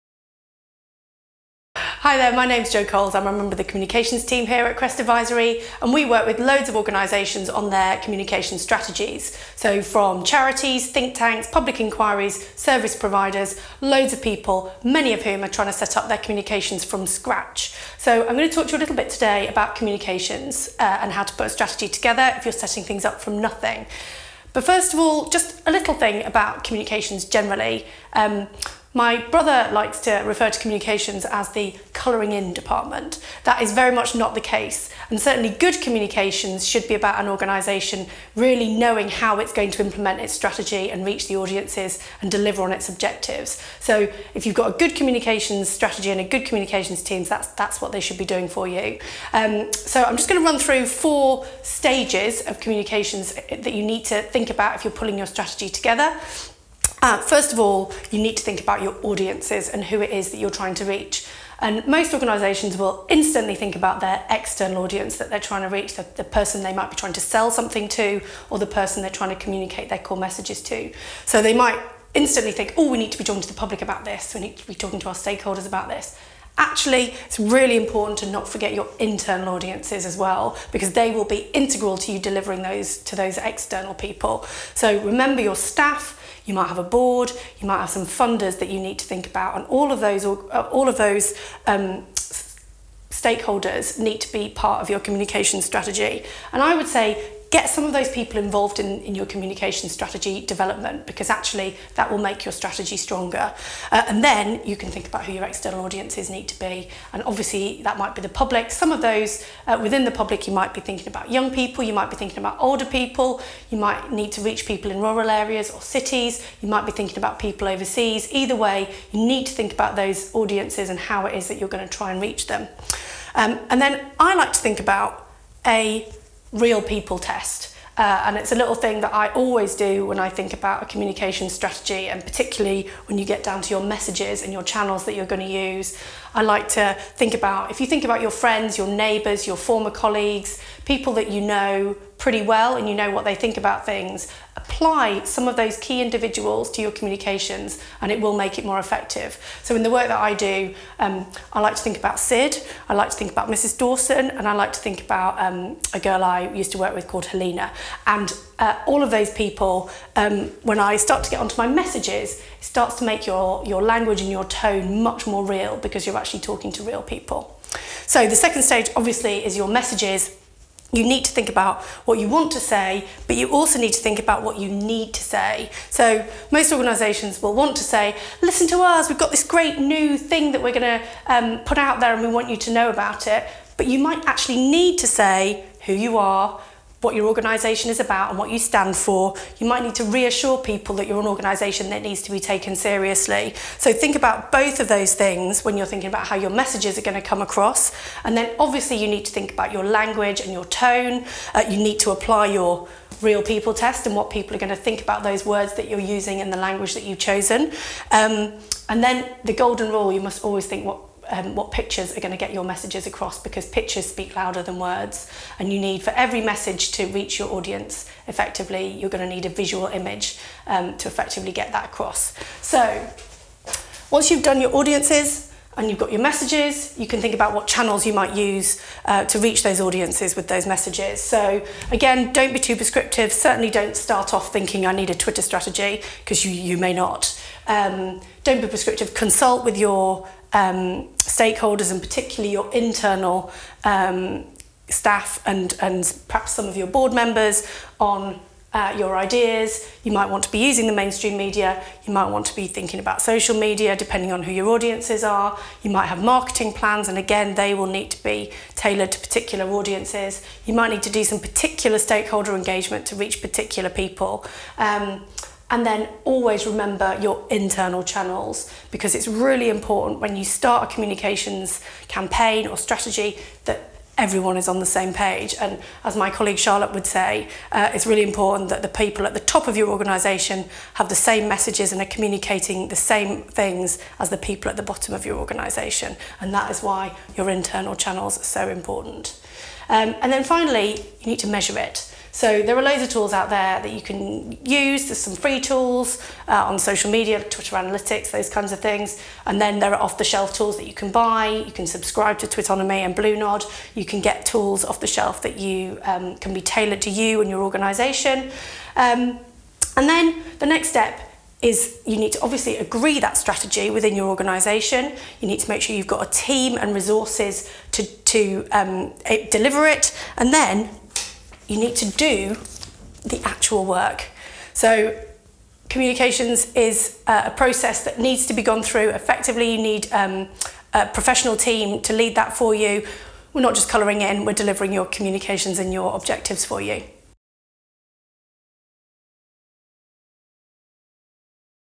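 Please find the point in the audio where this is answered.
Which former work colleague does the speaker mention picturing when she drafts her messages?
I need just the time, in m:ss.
2:37.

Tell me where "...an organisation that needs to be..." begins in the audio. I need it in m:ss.
3:11.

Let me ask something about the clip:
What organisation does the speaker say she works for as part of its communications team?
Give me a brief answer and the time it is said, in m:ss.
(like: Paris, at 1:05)
Crest Advisory, at 0:04.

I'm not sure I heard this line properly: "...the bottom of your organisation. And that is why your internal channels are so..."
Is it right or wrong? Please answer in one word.
right.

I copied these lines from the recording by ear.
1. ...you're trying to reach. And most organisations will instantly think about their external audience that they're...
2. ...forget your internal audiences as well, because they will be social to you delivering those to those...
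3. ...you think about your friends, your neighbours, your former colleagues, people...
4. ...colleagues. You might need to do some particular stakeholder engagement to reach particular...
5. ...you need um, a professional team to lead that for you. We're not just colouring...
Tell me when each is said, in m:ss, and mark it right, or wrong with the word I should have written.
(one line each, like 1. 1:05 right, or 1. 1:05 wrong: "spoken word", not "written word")
1. 1:00 right
2. 1:18 wrong: "integral", not "social"
3. 2:17 right
4. 4:19 wrong: "audiences", not "colleagues"
5. 5:29 right.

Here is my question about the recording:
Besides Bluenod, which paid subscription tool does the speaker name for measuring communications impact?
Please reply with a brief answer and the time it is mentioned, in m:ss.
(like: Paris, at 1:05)
Twitonomy, at 5:02.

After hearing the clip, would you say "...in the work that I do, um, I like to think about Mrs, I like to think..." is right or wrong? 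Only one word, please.
wrong.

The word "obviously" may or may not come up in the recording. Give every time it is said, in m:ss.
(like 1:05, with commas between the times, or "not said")
1:47, 2:48, 3:18, 5:12.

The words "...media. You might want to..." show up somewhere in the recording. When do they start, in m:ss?
4:11.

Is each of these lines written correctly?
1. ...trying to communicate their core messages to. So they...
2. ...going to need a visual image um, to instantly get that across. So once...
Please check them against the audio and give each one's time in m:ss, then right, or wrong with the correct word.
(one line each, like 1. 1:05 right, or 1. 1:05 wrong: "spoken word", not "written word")
1. 1:09 right
2. 3:39 wrong: "effectively", not "instantly".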